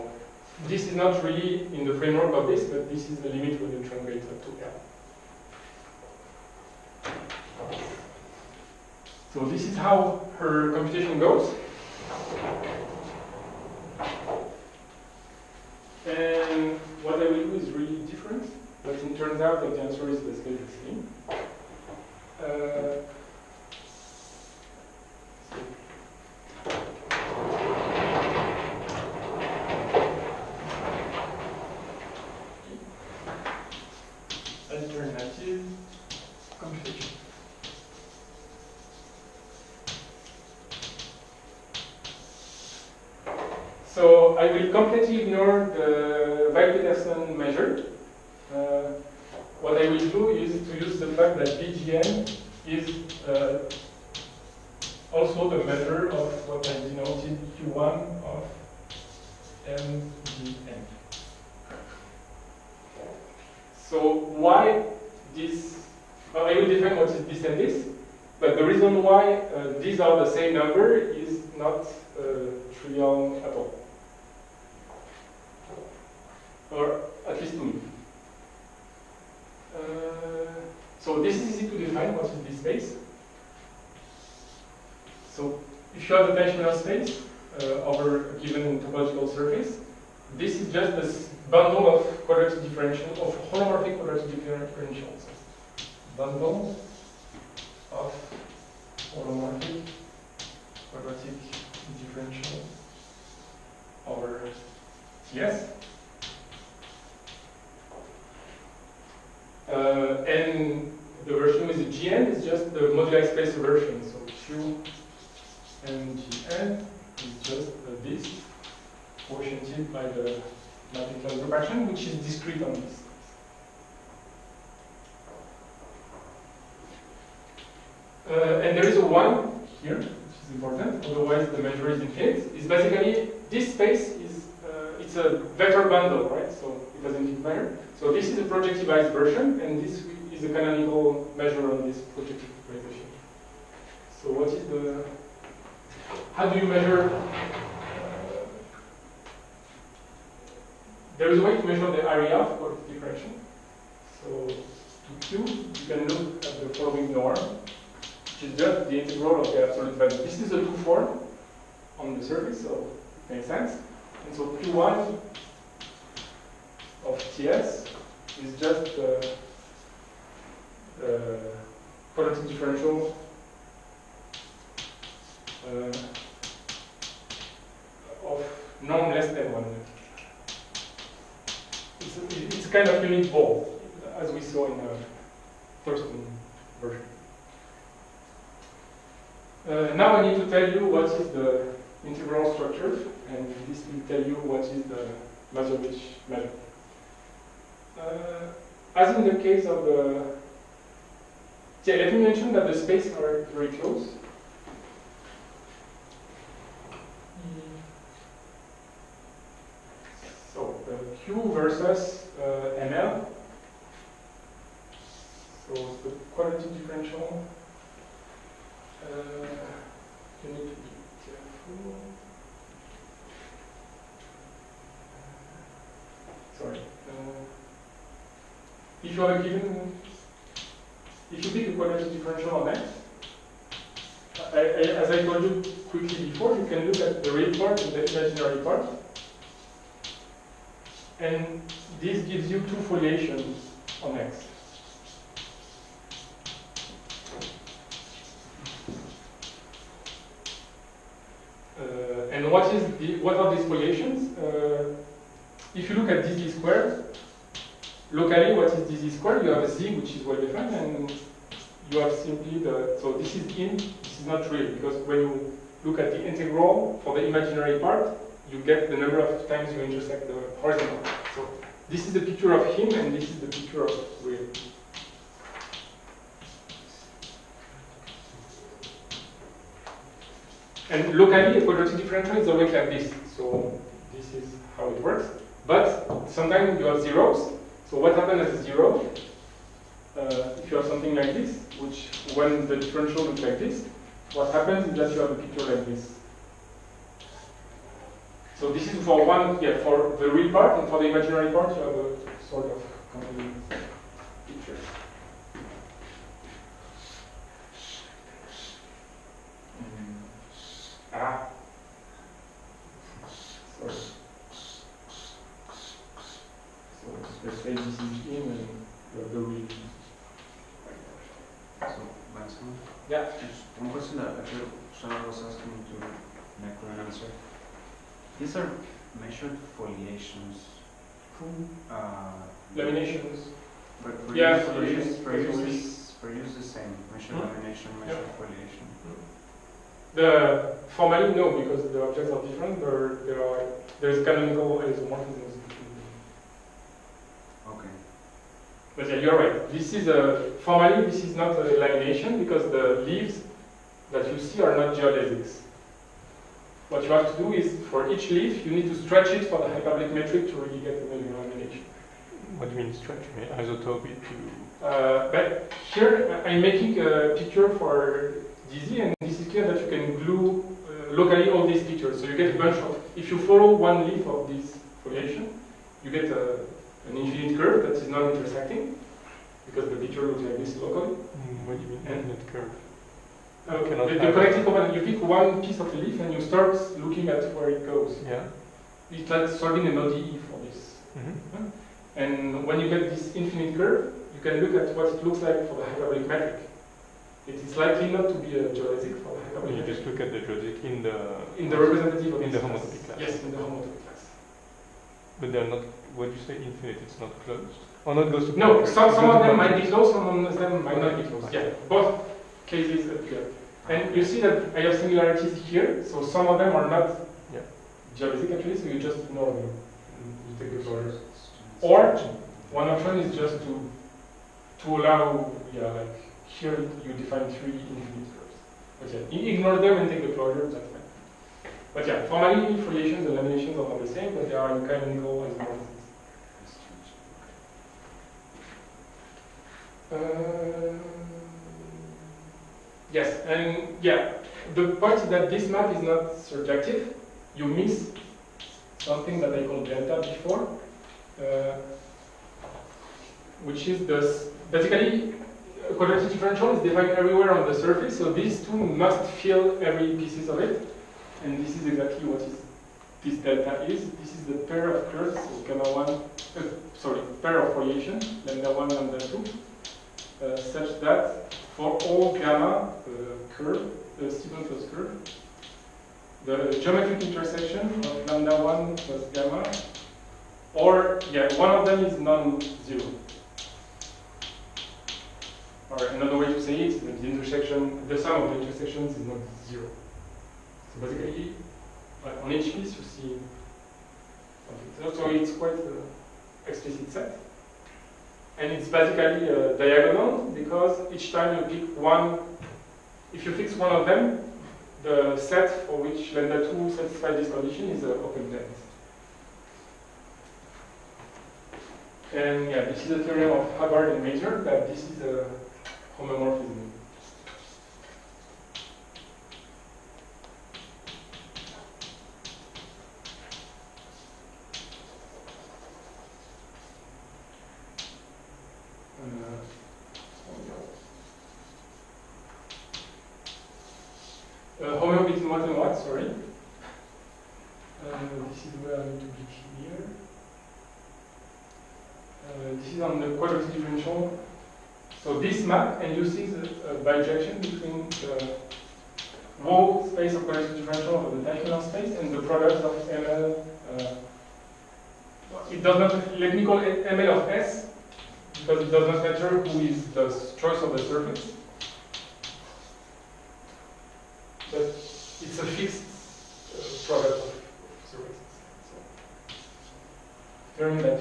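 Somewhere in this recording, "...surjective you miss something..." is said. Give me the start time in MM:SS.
07:26.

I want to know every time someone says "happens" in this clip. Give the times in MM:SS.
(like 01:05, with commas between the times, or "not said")
04:48, 04:54.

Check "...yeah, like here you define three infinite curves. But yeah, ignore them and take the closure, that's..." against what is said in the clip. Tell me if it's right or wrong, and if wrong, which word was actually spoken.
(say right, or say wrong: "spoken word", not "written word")
right.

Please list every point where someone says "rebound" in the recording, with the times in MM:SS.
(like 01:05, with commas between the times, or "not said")
not said.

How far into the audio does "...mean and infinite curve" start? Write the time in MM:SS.
06:21.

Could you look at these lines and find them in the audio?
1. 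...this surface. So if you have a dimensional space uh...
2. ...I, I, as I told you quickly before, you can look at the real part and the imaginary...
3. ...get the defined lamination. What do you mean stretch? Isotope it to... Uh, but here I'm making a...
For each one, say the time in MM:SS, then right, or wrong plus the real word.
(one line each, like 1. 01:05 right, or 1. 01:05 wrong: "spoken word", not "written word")
1. 01:22 wrong: "space", not "surface"
2. 03:54 right
3. 06:00 wrong: "measured", not "defined".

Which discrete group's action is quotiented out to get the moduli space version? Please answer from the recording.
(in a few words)
mathematical group.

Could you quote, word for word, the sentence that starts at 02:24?
So what is the, how do you measure, uh, there is a way to measure the area of the differential.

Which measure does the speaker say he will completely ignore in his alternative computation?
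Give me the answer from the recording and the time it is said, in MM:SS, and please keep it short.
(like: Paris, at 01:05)
Weil-Petersson measure, at 00:46.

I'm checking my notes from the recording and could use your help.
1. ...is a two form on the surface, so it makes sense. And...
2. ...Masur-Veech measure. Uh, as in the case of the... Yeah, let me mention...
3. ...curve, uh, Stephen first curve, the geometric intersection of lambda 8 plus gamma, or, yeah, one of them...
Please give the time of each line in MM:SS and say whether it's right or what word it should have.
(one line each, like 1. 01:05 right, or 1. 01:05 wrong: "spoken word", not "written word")
1. 02:40 right
2. 03:15 right
3. 07:53 wrong: "1", not "8".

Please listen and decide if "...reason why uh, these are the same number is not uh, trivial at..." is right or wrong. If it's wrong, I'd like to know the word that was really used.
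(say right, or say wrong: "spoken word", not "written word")
right.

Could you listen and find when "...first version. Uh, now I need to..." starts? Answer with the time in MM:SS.
03:05.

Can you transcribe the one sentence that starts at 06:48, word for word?
No, some, some of them might be closed, some of them might not be closed.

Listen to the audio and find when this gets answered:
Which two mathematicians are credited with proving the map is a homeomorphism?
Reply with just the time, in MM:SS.
08:33.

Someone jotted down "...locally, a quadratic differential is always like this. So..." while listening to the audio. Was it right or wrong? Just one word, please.
right.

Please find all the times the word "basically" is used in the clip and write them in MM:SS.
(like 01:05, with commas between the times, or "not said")
00:20, 02:12, 07:34, 08:11, 08:18.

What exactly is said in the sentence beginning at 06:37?
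It is likely not to be a geodesic for the hyperbolic You metric.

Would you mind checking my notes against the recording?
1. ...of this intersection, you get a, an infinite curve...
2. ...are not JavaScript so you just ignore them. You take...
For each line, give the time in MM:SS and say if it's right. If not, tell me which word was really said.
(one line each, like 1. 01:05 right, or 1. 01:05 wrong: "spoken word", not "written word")
1. 06:14 wrong: "foliation", not "intersection"
2. 06:56 right.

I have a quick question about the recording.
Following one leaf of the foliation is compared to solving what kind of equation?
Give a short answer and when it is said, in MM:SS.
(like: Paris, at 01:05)
an ODE, at 06:29.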